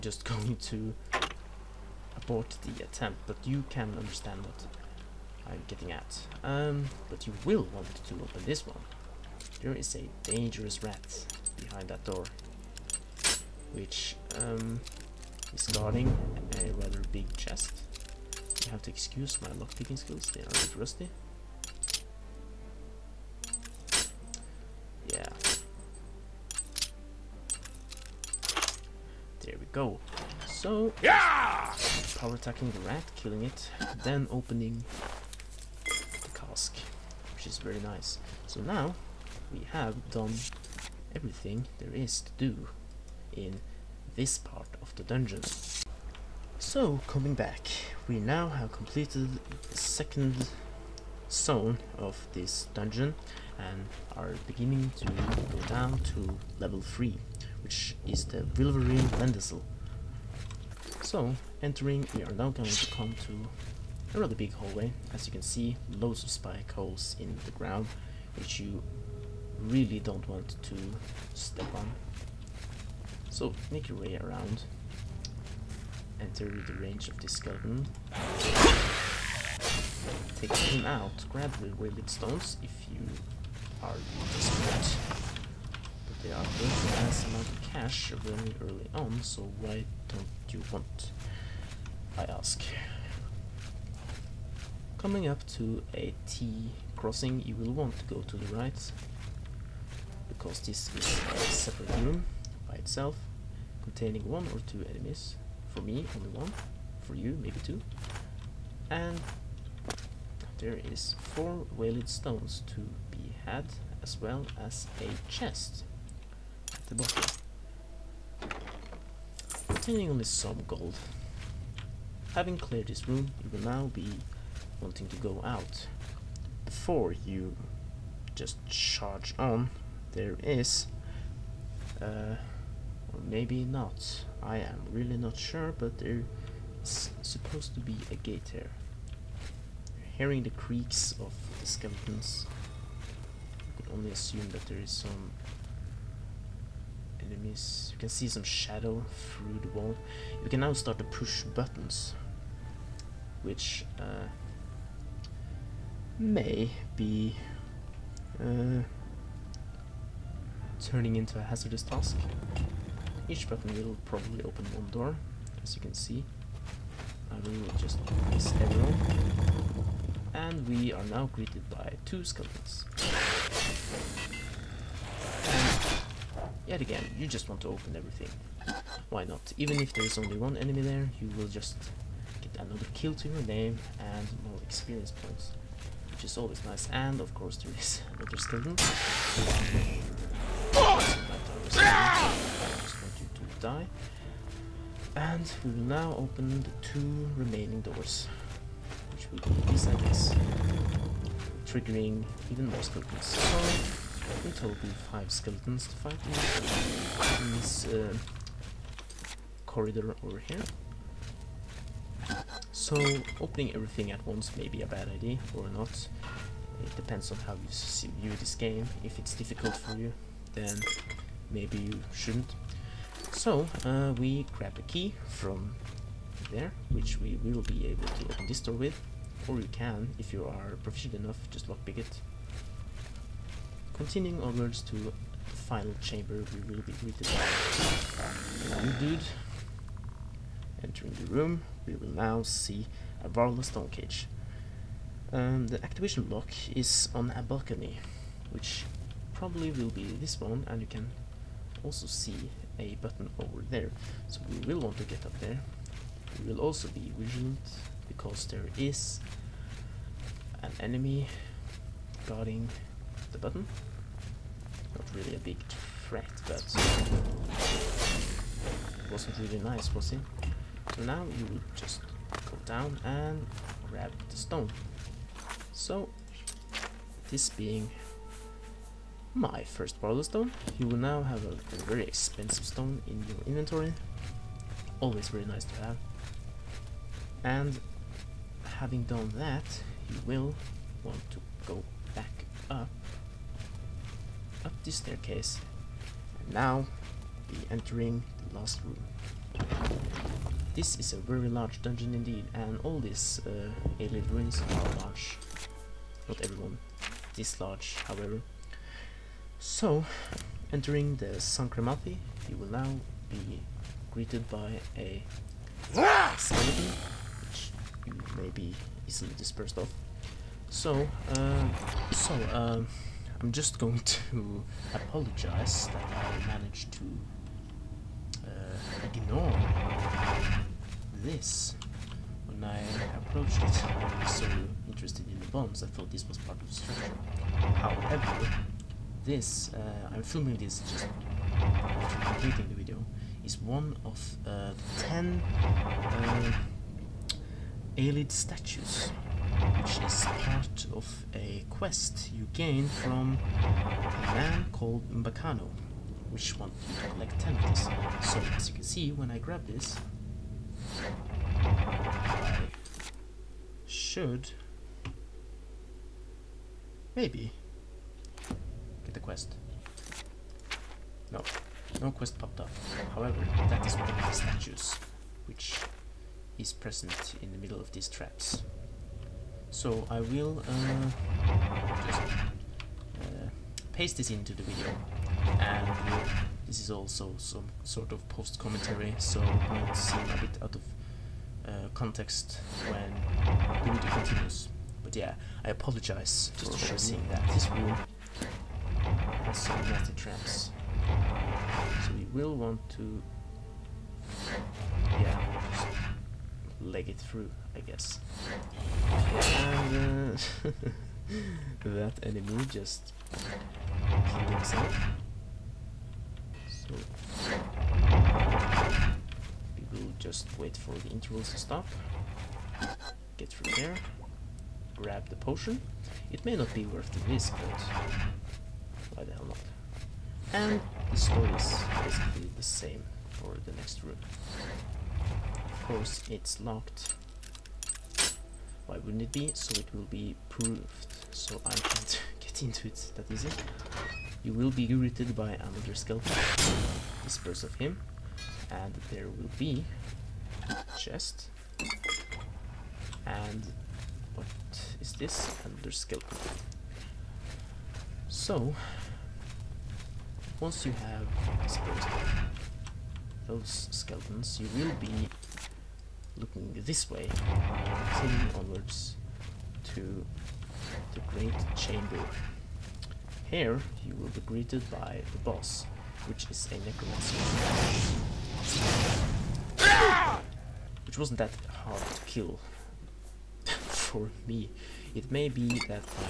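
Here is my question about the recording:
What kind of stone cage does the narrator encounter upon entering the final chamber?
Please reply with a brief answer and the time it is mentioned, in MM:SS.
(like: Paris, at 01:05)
Varla stone cage, at 04:03.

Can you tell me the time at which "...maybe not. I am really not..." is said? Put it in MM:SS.
02:13.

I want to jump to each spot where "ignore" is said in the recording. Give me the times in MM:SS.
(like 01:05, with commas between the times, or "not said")
05:29.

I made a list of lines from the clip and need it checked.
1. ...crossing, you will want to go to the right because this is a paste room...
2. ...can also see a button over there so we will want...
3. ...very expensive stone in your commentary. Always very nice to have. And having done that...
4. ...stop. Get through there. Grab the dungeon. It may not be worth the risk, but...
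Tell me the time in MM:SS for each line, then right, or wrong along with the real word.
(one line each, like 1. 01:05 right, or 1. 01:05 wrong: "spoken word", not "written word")
1. 01:36 wrong: "separate", not "paste"
2. 04:10 right
3. 04:41 wrong: "inventory", not "commentary"
4. 07:01 wrong: "potion", not "dungeon".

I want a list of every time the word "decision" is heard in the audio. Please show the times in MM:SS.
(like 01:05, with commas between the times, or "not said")
not said.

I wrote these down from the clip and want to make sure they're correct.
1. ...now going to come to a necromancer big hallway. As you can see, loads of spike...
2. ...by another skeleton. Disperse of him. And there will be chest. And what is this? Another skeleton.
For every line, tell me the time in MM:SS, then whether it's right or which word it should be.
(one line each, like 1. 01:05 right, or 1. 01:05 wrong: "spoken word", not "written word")
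1. 01:02 wrong: "rather", not "necromancer"
2. 07:25 right.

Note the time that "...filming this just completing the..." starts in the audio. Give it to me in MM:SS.
05:40.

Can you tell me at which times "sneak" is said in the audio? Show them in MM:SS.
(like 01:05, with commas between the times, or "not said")
01:13.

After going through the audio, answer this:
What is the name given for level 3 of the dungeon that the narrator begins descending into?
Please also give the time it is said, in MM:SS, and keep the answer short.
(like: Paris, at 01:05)
Vilverin Landisle, at 00:58.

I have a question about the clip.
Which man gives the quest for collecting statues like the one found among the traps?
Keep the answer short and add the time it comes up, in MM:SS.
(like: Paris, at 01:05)
Umbacano, at 05:55.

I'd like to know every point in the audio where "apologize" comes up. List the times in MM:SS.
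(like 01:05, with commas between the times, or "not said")
05:24, 06:35.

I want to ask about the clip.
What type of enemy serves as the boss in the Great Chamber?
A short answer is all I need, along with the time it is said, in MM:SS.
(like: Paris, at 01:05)
Necromancer, at 07:56.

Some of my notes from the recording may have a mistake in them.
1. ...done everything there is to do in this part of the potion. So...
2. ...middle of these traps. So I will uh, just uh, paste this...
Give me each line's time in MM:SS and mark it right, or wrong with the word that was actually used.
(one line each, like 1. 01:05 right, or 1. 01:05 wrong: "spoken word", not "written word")
1. 00:40 wrong: "dungeon", not "potion"
2. 06:17 right.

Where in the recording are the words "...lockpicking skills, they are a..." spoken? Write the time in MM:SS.
00:19.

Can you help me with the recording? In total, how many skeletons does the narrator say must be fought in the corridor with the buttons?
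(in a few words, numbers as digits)
5.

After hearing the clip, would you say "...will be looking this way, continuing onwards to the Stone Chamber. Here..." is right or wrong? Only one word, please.
wrong.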